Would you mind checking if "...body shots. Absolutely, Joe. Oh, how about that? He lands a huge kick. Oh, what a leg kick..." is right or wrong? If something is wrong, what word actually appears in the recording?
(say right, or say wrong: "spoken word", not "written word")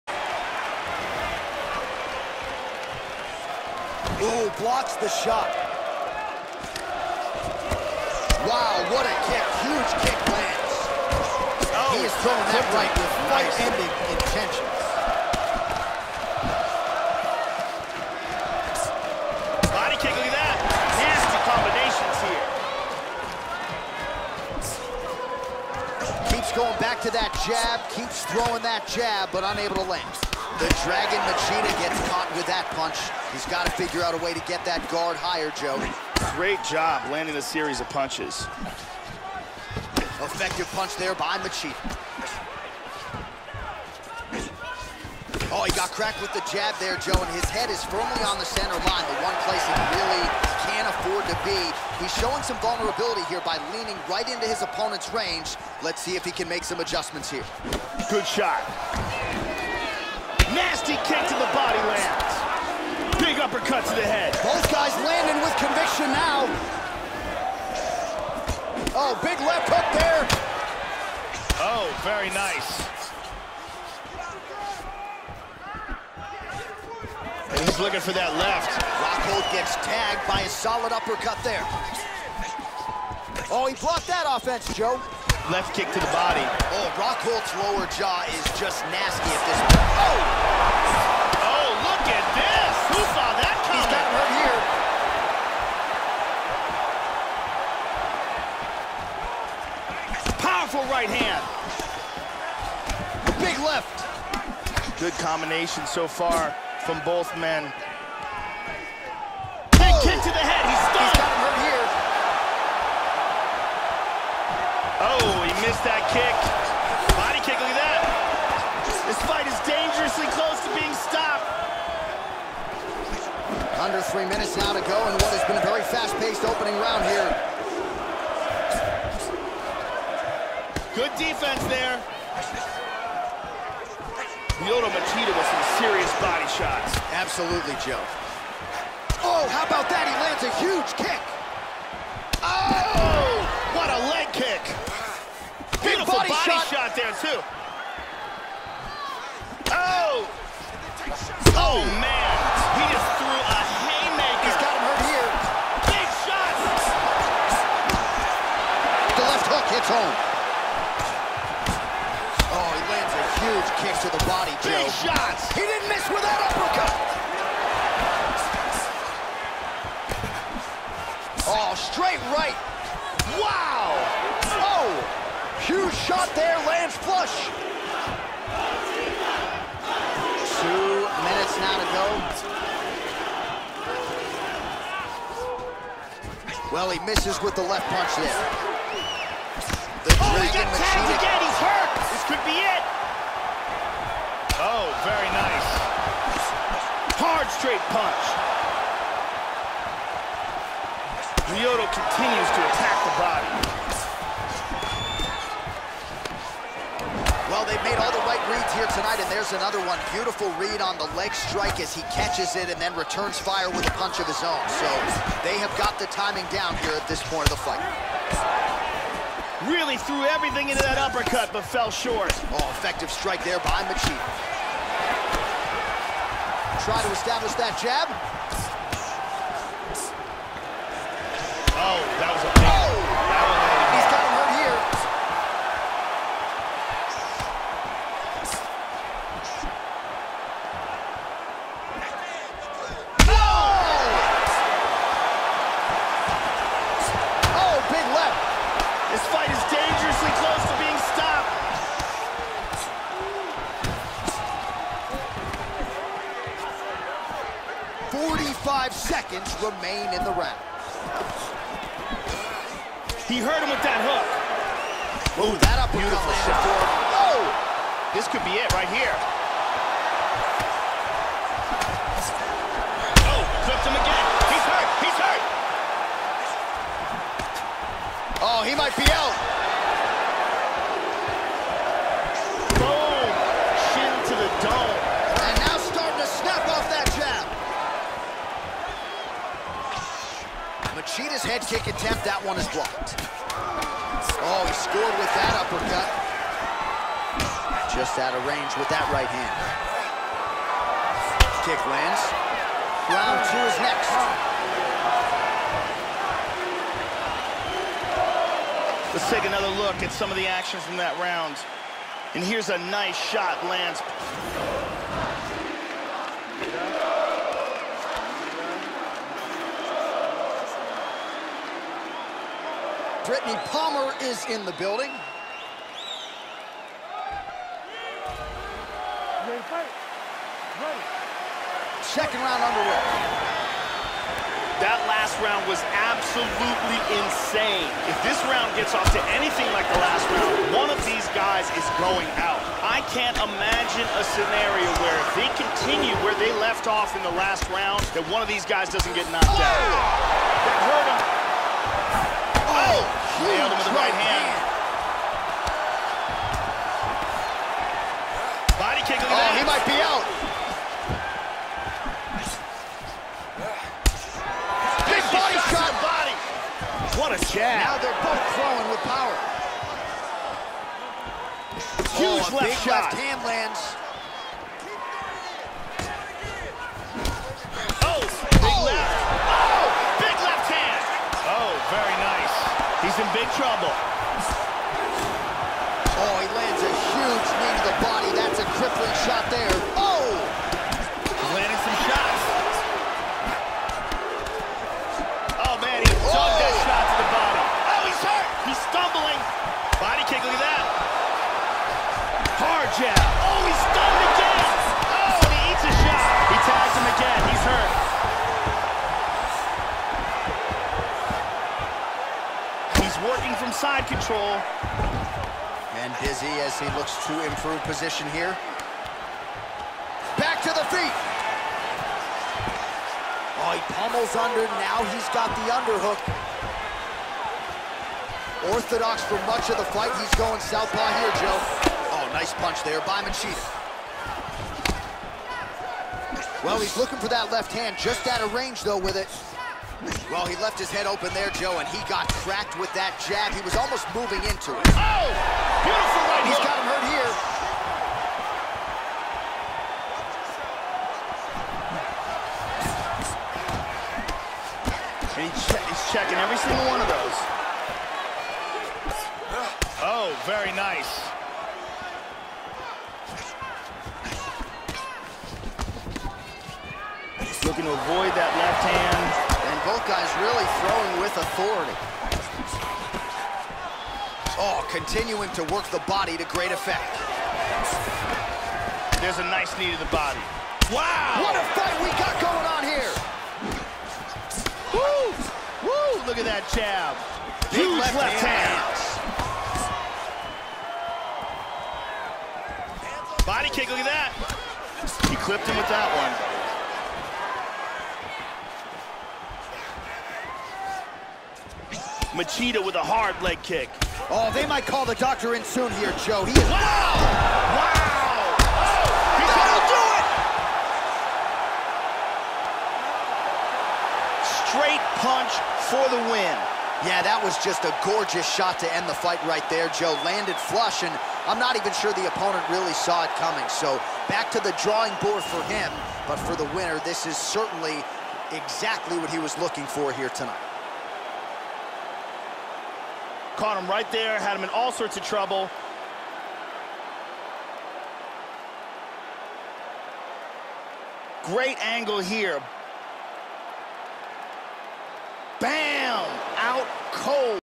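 right.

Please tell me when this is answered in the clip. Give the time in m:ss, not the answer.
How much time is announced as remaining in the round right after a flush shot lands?
3:00.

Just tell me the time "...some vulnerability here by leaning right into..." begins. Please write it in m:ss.
0:52.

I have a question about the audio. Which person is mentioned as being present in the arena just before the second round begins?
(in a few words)
Brittney Palmer.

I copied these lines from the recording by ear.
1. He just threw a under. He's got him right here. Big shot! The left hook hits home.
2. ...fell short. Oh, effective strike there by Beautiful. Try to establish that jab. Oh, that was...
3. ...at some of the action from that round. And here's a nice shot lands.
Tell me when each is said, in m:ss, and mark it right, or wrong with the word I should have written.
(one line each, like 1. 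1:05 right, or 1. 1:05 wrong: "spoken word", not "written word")
1. 2:32 wrong: "haymaker", not "under"
2. 3:41 wrong: "Machida", not "Beautiful"
3. 5:10 right.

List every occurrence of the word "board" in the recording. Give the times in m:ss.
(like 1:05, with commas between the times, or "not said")
8:45.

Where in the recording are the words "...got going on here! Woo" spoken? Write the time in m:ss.
8:02.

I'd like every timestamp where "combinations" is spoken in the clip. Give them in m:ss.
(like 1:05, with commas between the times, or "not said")
0:26, 1:45.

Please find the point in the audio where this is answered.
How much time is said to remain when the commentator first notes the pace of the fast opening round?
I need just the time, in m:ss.
2:03.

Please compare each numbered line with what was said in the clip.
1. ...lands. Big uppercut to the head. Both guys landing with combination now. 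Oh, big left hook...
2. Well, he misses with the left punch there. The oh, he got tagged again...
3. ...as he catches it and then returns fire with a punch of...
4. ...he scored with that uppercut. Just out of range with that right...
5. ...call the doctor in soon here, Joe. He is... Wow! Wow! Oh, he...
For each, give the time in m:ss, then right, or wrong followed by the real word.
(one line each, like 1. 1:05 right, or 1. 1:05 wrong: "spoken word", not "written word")
1. 1:01 wrong: "conviction", not "combination"
2. 3:06 right
3. 3:31 right
4. 4:54 right
5. 8:24 right.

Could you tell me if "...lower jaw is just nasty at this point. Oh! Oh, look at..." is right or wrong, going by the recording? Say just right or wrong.
right.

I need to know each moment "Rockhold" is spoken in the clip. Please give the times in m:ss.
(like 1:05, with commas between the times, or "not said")
1:18, 1:26.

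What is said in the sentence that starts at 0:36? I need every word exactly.
Great job landing a series of punches.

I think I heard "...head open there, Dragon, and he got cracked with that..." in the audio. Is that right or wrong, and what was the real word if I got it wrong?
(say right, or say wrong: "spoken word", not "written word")
wrong: "Joe", not "Dragon".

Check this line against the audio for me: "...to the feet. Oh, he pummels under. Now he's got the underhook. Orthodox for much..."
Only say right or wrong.
right.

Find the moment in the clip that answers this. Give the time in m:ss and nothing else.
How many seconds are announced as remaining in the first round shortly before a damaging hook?
4:18.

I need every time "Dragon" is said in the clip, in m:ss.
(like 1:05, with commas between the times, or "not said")
0:30.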